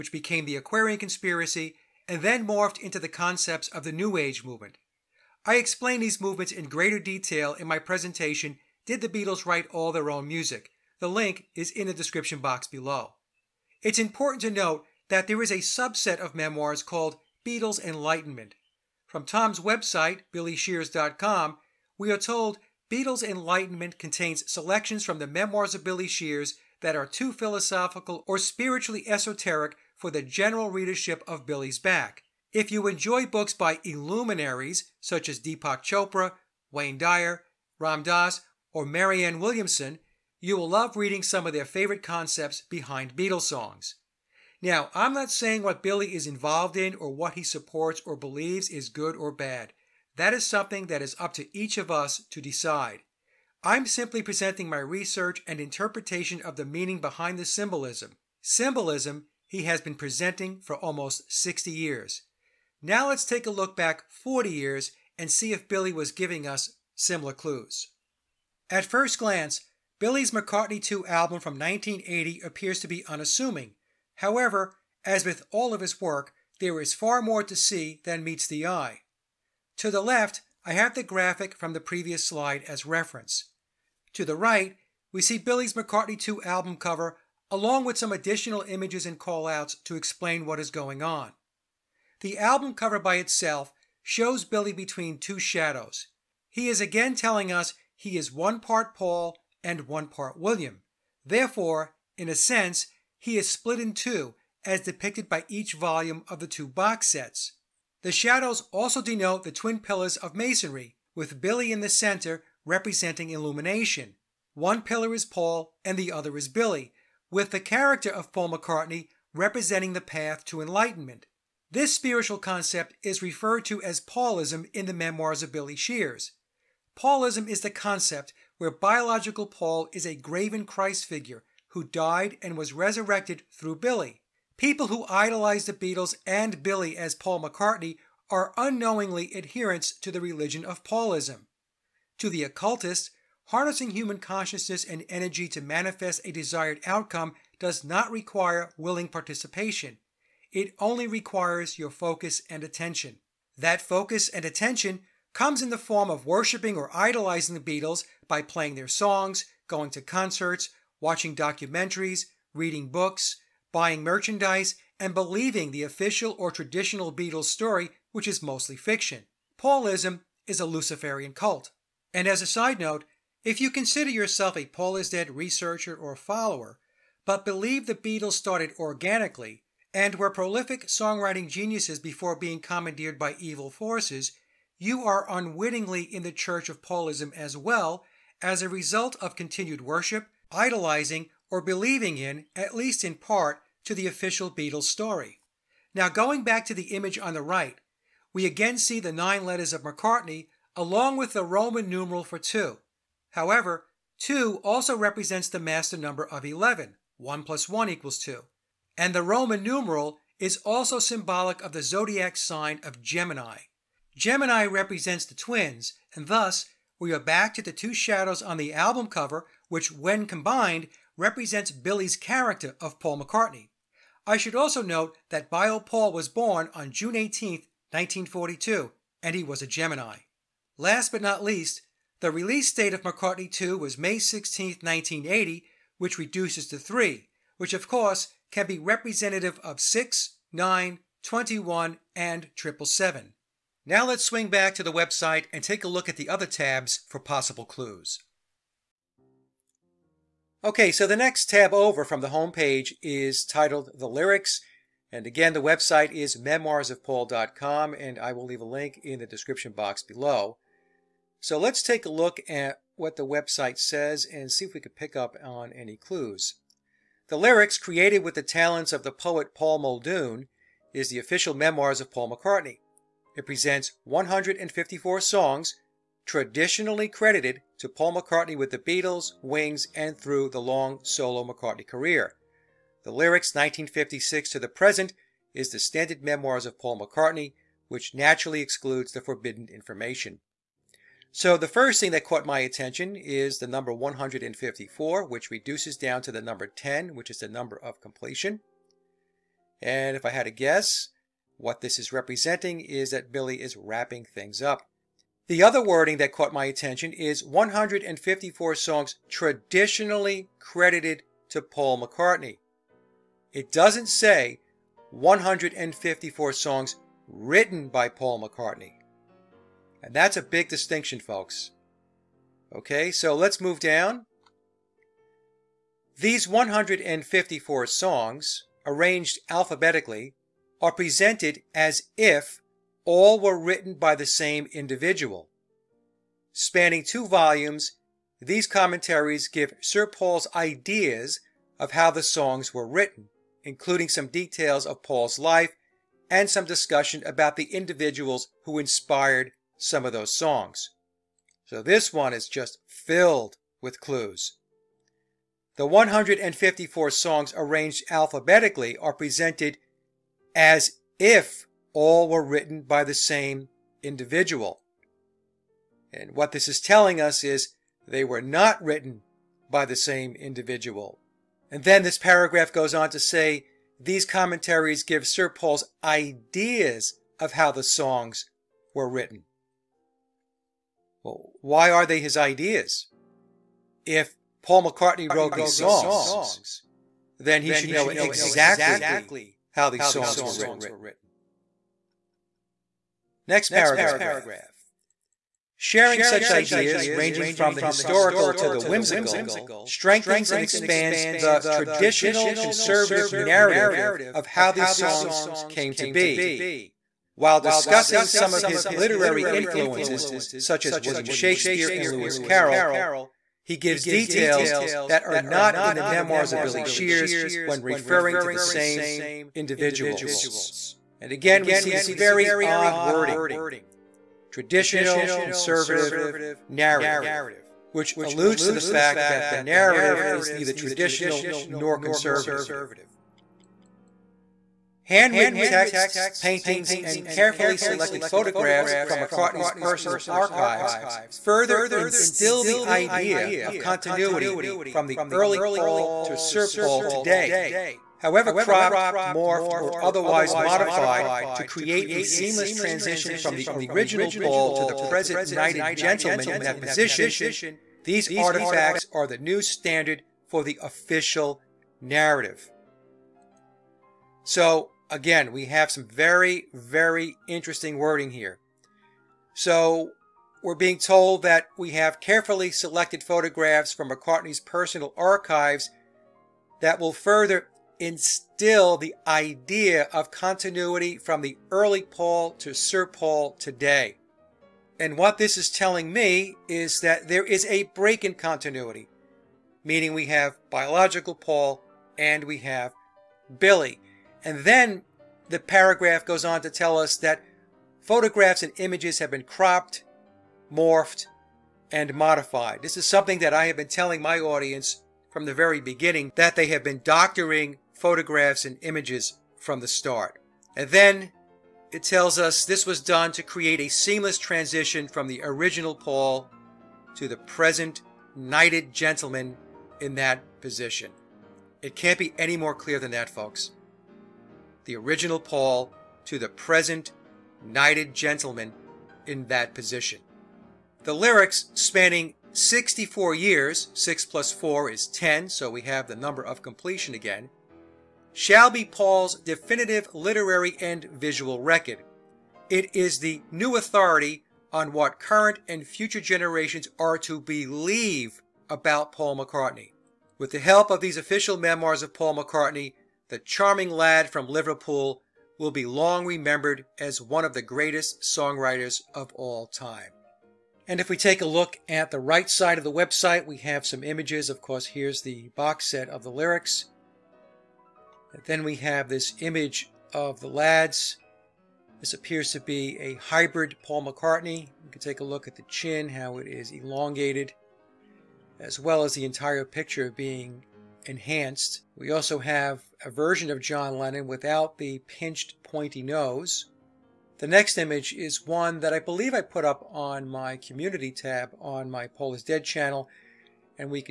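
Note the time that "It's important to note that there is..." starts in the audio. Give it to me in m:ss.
0:13.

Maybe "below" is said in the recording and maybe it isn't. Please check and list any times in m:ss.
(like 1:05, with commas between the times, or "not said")
0:12, 4:20.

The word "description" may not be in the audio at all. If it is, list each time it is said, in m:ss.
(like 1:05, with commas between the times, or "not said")
0:11, 4:19.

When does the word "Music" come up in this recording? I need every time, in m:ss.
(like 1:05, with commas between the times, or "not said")
0:10.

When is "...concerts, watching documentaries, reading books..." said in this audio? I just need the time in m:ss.
2:40.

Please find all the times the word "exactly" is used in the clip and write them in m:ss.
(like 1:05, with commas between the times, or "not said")
6:28.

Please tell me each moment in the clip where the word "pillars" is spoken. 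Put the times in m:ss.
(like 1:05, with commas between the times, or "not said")
1:49, 1:54.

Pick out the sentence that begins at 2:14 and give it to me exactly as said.
People who idolize the Beatles and Billy as Paul McCartney are unknowingly adherents to the religion of Paulism.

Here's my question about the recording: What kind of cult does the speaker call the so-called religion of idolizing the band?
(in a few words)
Luciferian.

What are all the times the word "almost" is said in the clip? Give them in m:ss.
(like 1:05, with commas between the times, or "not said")
1:00.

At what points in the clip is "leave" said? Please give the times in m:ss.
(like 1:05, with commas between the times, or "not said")
4:18.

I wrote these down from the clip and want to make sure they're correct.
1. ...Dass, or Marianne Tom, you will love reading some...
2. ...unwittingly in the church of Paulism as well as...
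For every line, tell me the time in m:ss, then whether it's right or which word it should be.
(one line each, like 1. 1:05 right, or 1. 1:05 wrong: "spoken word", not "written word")
1. 0:38 wrong: "Williamson", not "Tom"
2. 3:05 right.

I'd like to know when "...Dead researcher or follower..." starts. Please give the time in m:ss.
2:55.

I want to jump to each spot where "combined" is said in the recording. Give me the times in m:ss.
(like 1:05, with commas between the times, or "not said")
3:40.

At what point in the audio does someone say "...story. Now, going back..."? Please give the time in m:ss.
3:14.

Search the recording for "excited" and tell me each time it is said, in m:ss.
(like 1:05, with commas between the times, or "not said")
not said.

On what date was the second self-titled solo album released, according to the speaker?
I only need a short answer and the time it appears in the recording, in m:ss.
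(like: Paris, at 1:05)
May 16, 1980, at 3:53.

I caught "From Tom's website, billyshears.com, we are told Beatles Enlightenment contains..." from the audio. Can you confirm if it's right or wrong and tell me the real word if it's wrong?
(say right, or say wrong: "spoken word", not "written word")
right.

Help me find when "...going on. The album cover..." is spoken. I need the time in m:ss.
1:30.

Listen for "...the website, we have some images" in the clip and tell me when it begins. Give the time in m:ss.
9:22.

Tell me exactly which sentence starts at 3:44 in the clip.
I should also note that Bio Paul was born on June 18, 1942, and he was a Gemini.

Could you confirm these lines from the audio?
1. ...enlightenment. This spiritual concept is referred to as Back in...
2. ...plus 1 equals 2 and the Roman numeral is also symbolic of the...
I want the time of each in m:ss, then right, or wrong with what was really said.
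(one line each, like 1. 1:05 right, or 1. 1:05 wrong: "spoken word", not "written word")
1. 2:00 wrong: "Paulism", not "Back"
2. 3:27 right.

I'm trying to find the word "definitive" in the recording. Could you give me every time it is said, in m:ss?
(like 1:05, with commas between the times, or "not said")
8:59.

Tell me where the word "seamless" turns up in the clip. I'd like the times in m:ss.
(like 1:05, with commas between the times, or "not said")
7:32, 8:33.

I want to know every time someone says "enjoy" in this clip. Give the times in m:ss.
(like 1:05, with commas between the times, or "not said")
0:32.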